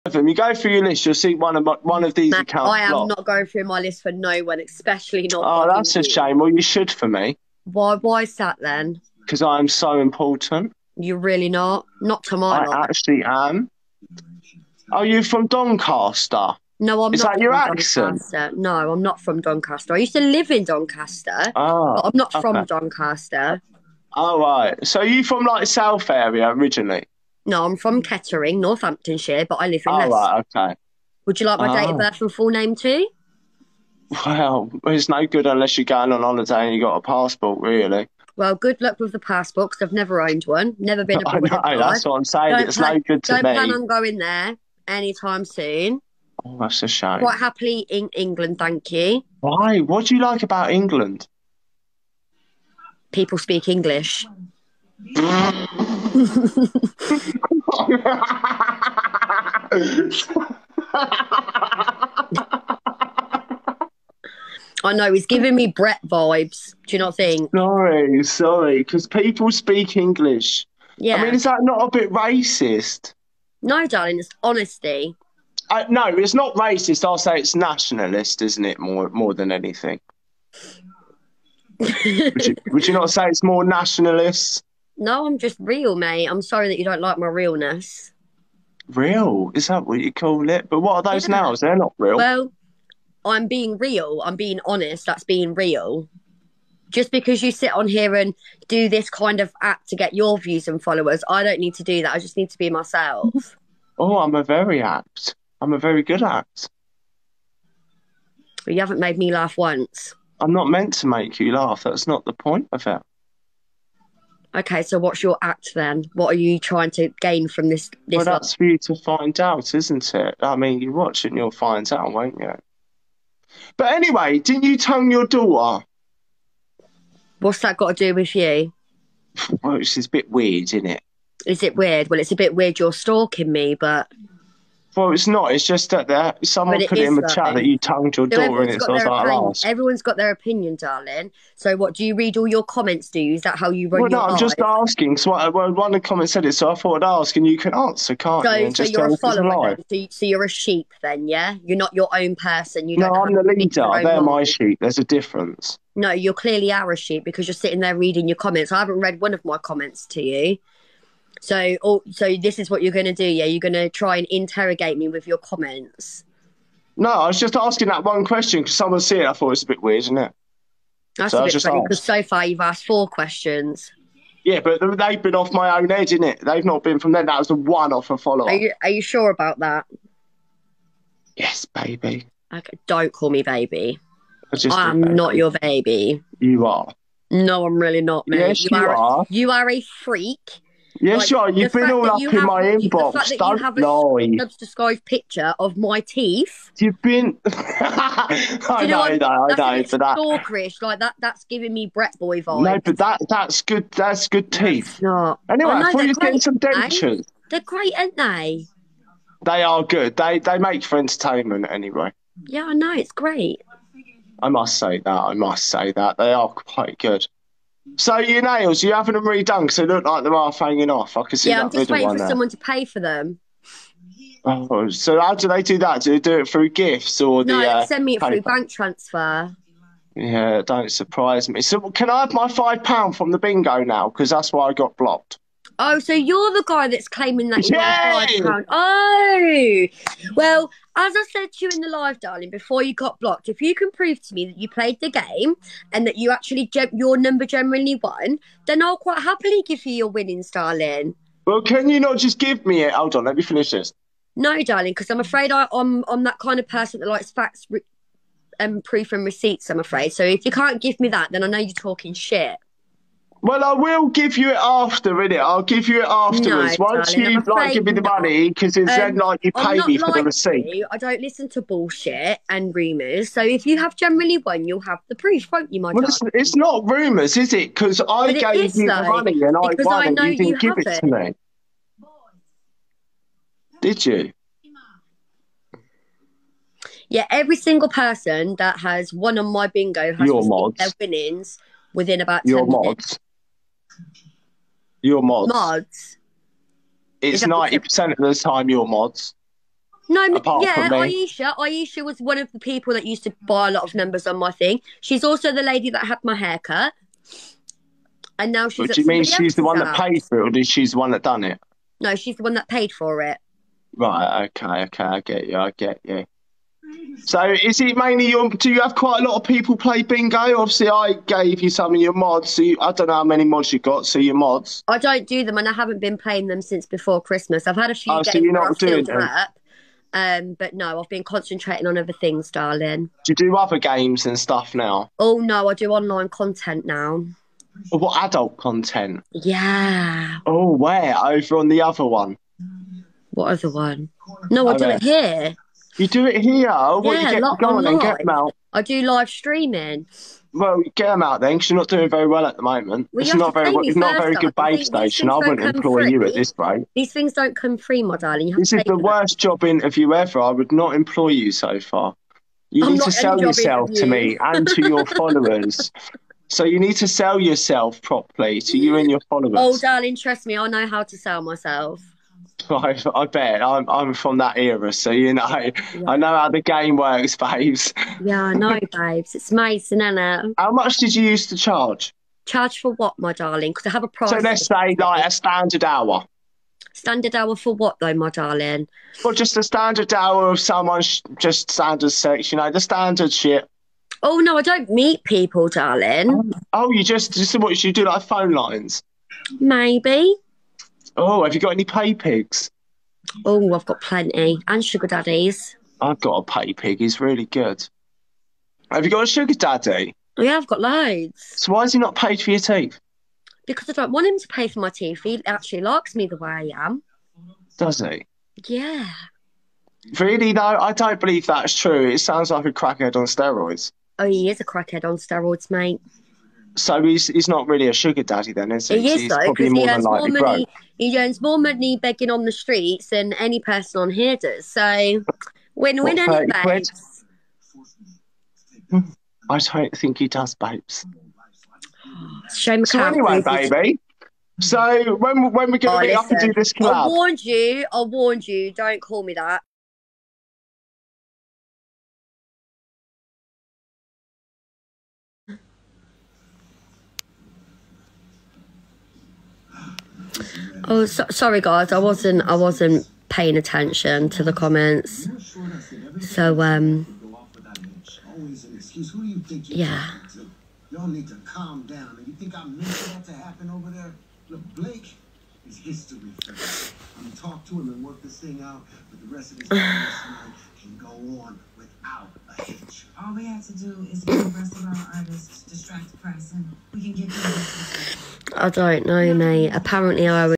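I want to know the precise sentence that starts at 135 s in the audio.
It's just that there, someone put it in the chat that you tongued your so daughter, and it sounds like opinion.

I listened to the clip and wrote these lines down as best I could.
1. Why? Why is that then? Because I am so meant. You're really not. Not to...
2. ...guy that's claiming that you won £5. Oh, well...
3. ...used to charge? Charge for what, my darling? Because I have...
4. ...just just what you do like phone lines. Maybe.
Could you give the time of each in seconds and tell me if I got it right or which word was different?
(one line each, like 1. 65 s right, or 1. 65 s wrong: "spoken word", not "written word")
1. 7 s wrong: "important", not "meant"
2. 236 s right
3. 381 s right
4. 397 s right.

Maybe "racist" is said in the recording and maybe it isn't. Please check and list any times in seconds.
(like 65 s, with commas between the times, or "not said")
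72 s, 76 s.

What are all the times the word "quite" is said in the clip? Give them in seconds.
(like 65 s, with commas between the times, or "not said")
47 s, 216 s, 248 s, 318 s.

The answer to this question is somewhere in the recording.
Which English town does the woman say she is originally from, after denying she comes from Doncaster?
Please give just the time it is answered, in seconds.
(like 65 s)
28 s.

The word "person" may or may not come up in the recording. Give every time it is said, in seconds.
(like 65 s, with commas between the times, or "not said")
152 s, 256 s, 287 s, 433 s.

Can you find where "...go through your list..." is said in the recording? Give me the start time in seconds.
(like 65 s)
0 s.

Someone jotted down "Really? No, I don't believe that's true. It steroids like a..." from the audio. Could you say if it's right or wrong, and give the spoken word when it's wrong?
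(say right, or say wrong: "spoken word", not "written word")
wrong: "sounds", not "steroids".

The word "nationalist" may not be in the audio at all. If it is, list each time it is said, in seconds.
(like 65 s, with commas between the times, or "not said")
77 s, 83 s.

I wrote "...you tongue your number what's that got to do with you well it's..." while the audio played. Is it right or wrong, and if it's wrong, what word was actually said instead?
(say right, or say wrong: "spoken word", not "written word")
wrong: "daughter", not "number".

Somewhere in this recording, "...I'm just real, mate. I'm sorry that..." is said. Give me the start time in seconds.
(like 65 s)
85 s.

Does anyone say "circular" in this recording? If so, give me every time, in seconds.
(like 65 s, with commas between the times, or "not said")
not said.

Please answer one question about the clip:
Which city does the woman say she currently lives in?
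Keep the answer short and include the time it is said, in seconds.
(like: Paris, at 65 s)
Leicester, at 29 s.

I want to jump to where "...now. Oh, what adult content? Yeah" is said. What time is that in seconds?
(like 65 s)
336 s.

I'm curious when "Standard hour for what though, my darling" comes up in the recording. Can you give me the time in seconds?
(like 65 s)
386 s.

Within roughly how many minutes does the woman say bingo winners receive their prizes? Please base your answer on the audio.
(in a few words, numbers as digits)
10 minutes.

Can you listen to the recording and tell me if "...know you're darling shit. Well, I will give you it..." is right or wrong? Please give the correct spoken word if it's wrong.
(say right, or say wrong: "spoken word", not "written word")
wrong: "talking", not "darling".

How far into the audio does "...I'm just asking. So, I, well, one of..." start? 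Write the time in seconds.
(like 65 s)
144 s.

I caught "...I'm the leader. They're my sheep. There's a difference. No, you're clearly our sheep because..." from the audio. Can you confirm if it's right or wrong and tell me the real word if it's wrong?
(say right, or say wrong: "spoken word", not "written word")
right.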